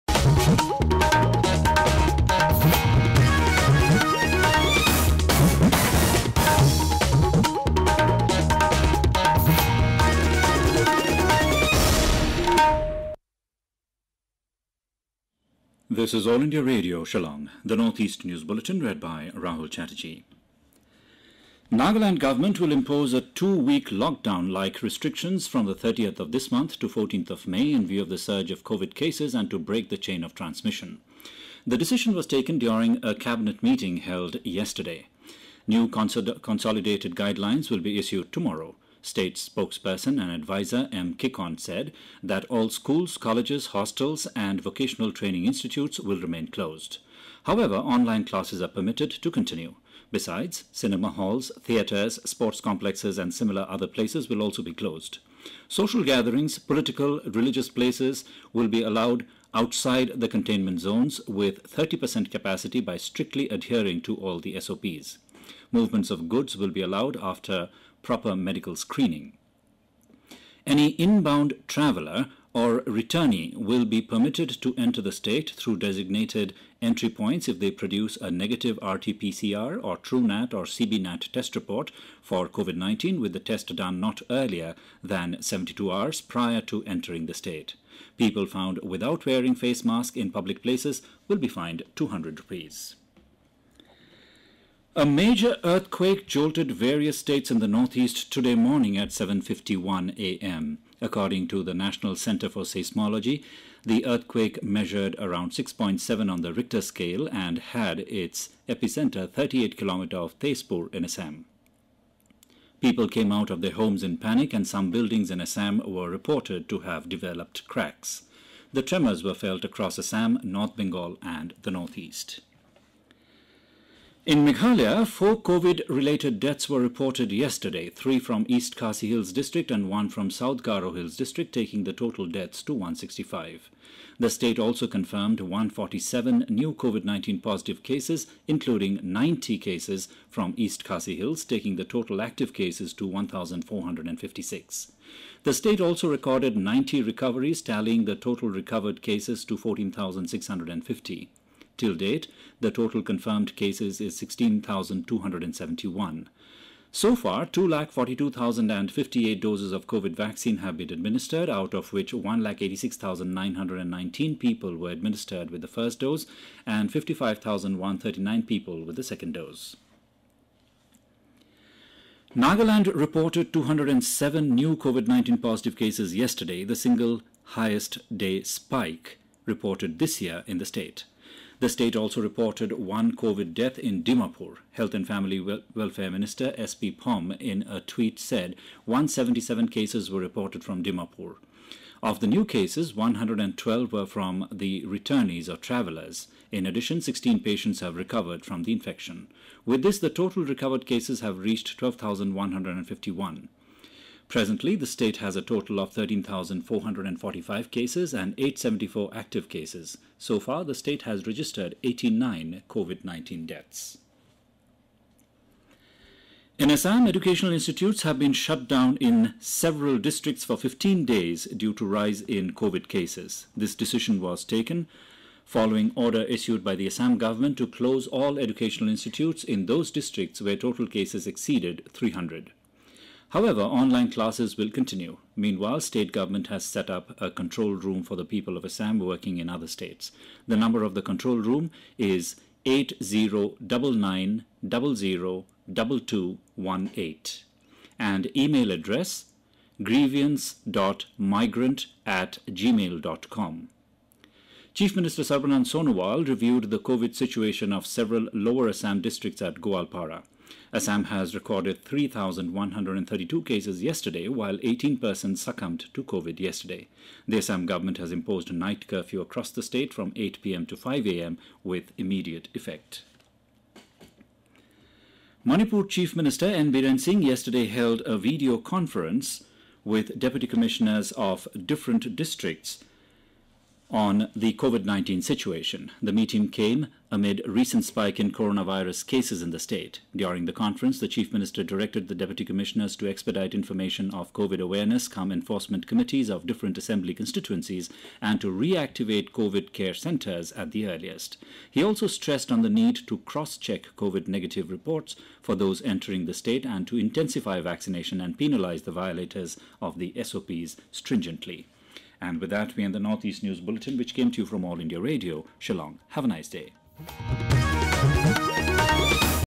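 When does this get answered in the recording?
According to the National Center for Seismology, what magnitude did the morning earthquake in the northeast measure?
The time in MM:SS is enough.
01:45.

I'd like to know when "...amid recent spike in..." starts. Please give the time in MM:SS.
04:47.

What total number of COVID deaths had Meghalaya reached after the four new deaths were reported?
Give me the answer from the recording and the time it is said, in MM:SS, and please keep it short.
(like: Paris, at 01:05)
165, at 02:12.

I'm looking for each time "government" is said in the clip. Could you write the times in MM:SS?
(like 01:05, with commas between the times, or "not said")
00:22, 03:47, 03:56, 04:27.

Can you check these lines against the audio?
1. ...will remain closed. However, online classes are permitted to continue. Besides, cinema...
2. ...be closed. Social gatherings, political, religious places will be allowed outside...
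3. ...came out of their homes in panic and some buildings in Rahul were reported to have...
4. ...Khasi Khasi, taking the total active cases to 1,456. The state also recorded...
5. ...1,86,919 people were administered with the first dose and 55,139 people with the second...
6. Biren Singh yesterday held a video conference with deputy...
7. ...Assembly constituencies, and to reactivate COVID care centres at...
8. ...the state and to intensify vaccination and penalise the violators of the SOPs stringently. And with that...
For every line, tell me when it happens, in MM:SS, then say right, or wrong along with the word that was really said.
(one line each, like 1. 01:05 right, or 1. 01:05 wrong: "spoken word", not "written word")
1. 00:45 right
2. 00:54 right
3. 01:53 wrong: "Assam", not "Rahul"
4. 02:20 wrong: "Hills", not "Khasi"
5. 02:42 right
6. 04:36 right
7. 04:56 right
8. 05:06 right.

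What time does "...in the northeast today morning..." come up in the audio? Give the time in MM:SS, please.
01:37.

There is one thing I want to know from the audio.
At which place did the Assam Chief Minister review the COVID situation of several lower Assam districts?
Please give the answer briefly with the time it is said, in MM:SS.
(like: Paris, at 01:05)
Goalpara, at 04:19.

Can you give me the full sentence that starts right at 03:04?
Health and Family Wel Welfare Minister SP Phom in a tweet said 177 cases were reported from Dimapur.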